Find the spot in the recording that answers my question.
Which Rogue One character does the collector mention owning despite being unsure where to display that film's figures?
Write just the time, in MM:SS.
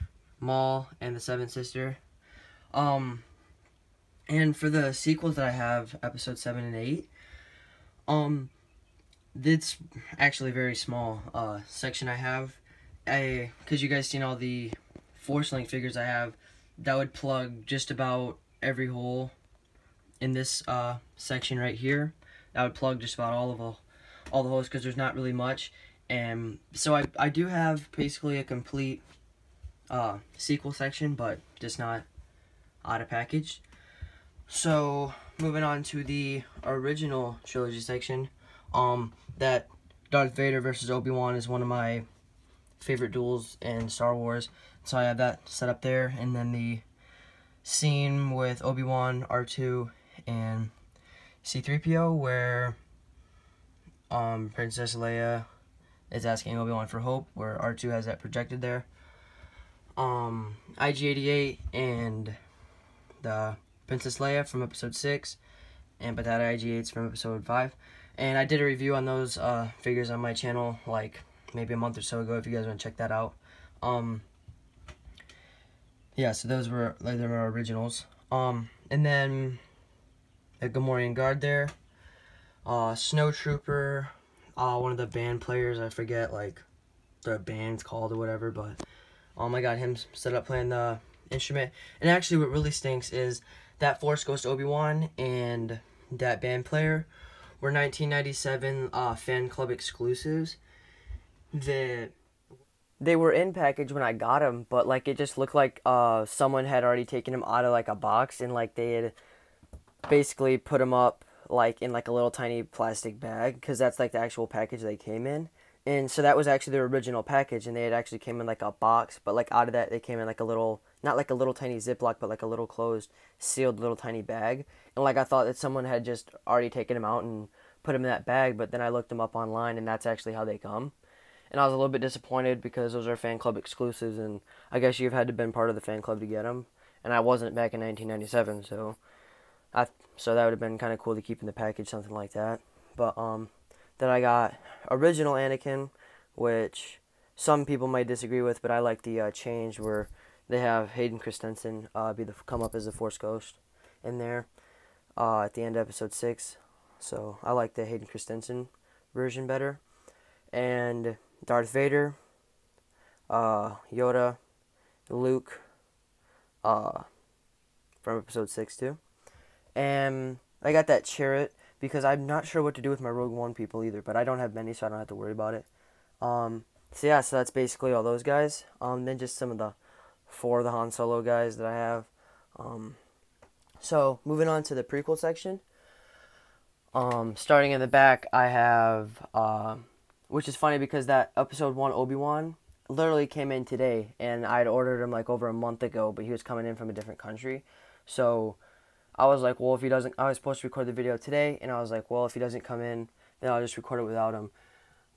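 02:51.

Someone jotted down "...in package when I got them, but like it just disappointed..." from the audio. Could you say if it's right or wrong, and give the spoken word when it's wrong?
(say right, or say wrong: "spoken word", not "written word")
wrong: "looked", not "disappointed".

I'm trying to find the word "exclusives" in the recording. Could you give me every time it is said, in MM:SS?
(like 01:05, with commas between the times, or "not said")
01:39, 02:13.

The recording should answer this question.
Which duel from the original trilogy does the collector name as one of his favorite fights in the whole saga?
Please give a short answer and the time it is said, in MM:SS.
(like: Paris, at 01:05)
Darth Vader versus Obi-Wan, at 00:40.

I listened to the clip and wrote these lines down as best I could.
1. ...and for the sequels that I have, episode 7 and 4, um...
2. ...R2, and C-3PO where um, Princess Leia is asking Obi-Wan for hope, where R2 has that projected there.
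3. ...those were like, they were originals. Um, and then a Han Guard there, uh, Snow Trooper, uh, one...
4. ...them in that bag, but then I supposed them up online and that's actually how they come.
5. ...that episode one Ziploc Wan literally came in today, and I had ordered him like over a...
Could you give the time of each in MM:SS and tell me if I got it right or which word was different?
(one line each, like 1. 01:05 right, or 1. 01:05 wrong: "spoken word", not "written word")
1. 00:04 wrong: "8", not "4"
2. 00:49 right
3. 01:16 wrong: "Gamorrean", not "Han"
4. 02:07 wrong: "looked", not "supposed"
5. 03:11 wrong: "Obi", not "Ziploc".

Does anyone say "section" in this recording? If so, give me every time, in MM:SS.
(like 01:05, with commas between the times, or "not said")
00:11, 00:21, 00:30, 00:37, 03:05.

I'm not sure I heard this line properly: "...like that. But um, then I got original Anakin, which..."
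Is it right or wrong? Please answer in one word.
right.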